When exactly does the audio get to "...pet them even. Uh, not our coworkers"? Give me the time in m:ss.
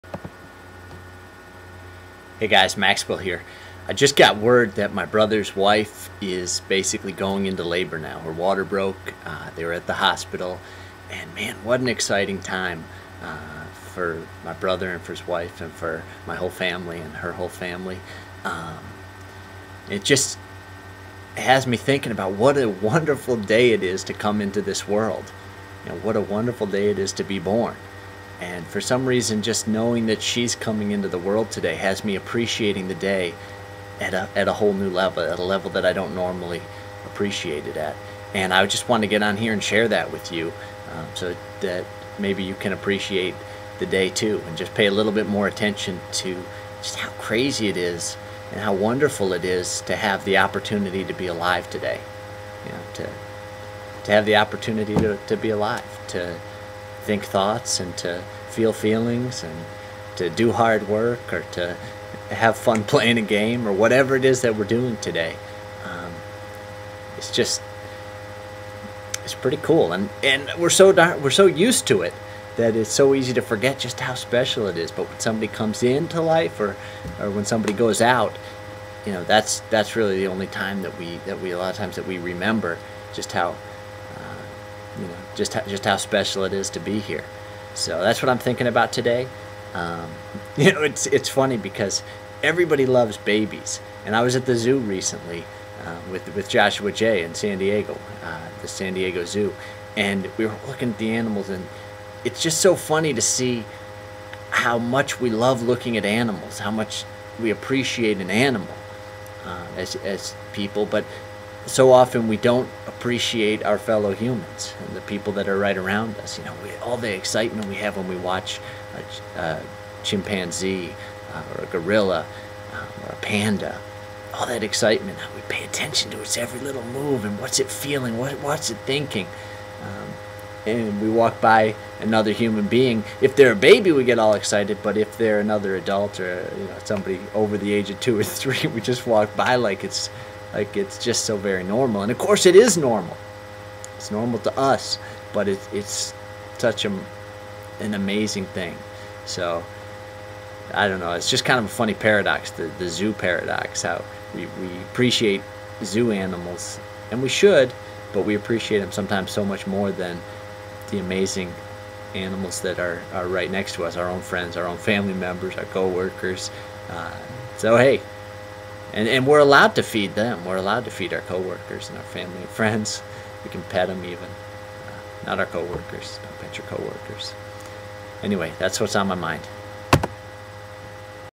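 2:53.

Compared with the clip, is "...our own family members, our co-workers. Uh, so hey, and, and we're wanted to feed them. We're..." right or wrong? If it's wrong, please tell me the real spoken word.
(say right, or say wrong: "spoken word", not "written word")
wrong: "allowed", not "wanted".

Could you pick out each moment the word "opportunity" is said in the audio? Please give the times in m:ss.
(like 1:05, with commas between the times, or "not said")
0:50, 0:54.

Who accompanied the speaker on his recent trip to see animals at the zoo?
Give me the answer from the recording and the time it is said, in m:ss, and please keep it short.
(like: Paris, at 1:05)
Joshua Jay, at 1:36.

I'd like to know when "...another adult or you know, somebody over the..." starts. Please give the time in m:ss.
2:15.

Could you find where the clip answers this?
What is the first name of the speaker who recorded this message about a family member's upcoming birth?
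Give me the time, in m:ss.
0:02.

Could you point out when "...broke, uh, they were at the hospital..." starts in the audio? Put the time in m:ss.
0:08.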